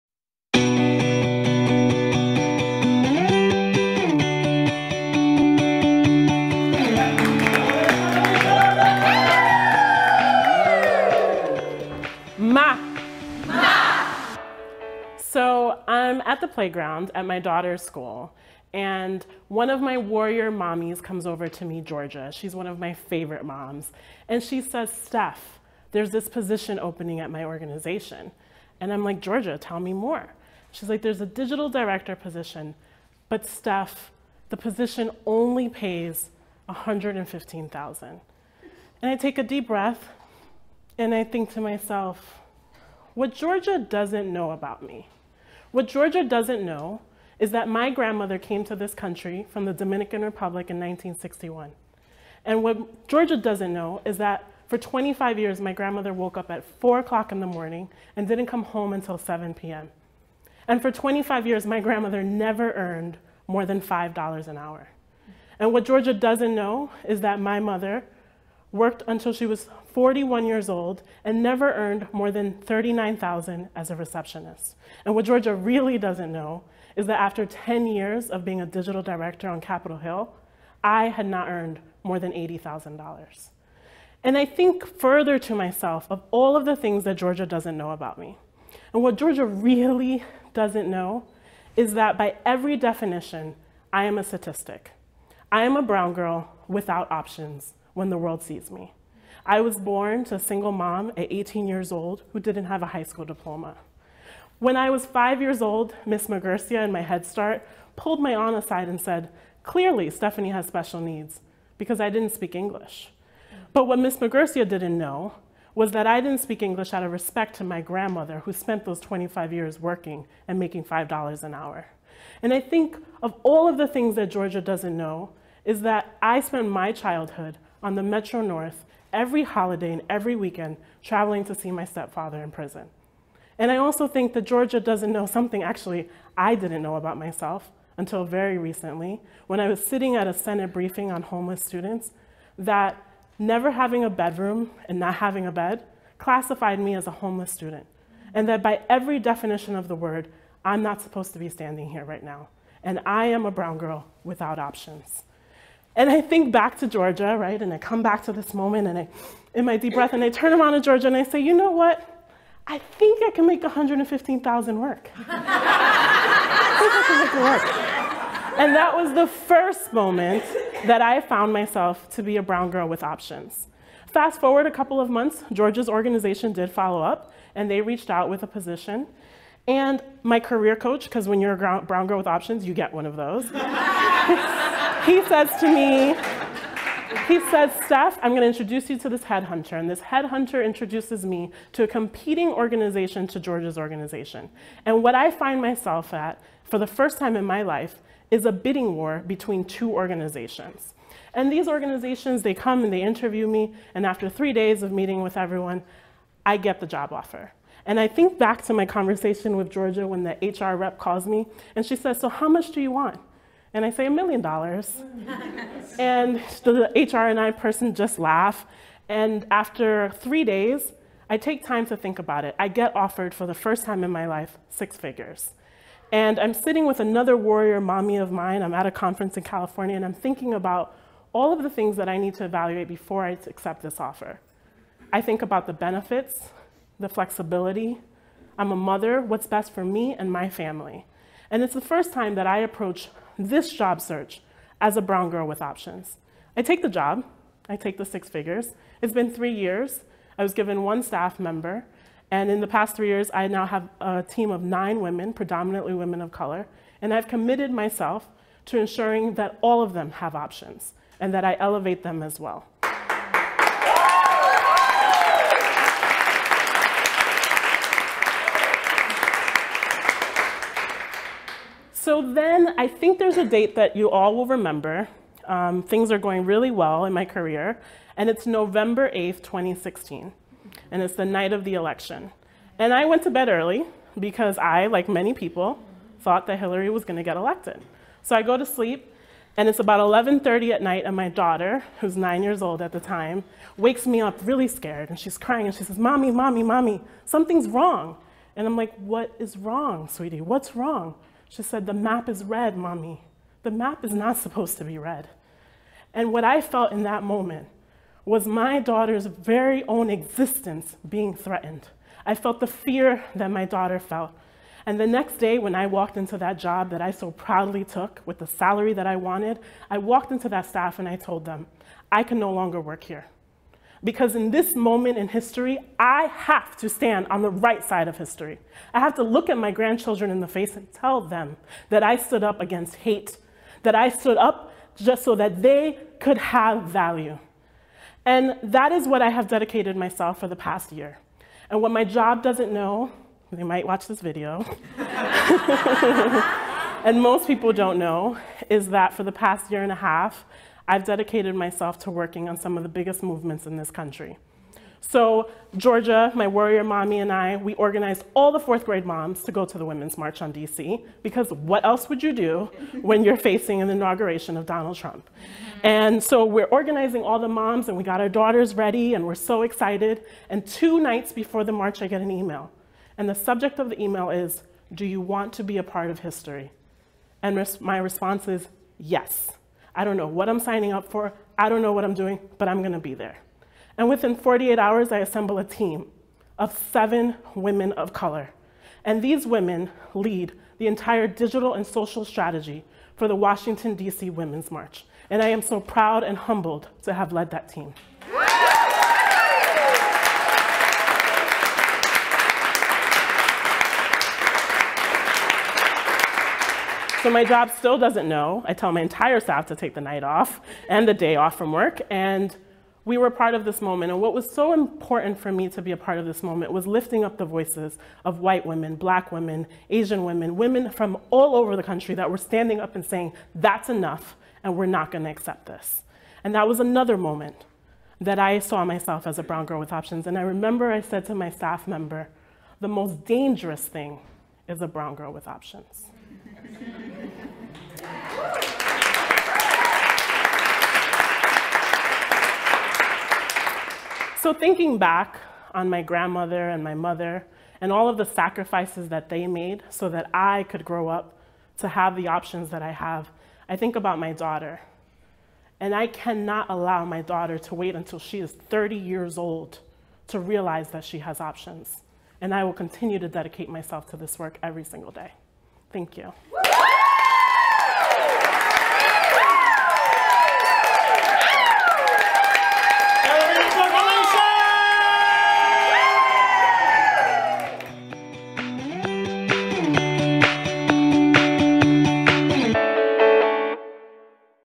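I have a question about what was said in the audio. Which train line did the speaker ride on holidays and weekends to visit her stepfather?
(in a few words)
Metro North.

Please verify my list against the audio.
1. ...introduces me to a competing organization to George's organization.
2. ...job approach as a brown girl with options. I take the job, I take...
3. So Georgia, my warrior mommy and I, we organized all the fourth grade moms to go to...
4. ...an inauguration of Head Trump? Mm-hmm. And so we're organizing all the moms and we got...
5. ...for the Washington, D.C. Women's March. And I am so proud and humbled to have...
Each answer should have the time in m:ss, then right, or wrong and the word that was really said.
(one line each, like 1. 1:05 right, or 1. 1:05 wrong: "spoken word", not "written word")
1. 3:10 right
2. 4:03 wrong: "search", not "approach"
3. 5:54 right
4. 6:03 wrong: "Donald", not "Head"
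5. 6:33 right.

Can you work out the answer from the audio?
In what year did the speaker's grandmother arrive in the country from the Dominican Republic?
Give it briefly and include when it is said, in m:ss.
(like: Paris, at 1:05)
1961, at 0:50.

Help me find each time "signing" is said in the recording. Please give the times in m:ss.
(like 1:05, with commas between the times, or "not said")
6:20.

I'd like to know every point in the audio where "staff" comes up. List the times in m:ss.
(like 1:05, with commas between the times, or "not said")
4:11, 5:20, 6:49, 7:11.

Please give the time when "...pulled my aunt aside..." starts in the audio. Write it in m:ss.
1:47.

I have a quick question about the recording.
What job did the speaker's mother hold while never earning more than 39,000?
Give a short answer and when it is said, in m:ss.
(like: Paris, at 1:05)
Receptionist, at 1:13.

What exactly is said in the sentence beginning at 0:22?
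She's one of my favorite moms.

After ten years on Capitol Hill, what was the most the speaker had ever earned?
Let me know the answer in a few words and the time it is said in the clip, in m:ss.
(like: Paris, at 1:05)
$80,000, at 1:22.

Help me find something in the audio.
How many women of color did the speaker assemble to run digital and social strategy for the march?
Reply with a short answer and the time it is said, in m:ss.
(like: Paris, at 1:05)
7, at 6:26.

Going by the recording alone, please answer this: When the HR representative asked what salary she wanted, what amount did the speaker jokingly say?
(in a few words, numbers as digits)
A million dollars.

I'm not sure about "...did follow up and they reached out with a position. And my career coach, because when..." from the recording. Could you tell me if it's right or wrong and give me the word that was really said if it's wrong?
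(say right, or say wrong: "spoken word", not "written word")
right.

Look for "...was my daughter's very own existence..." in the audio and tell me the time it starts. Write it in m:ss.
5:08.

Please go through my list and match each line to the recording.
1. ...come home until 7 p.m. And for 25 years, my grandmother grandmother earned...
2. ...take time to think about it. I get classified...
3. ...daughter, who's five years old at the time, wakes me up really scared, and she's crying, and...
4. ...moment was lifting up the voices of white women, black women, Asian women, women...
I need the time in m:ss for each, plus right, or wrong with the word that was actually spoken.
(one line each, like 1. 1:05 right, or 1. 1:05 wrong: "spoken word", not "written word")
1. 0:58 wrong: "never", not "grandmother"
2. 3:41 wrong: "offered", not "classified"
3. 4:51 wrong: "nine", not "five"
4. 6:56 right.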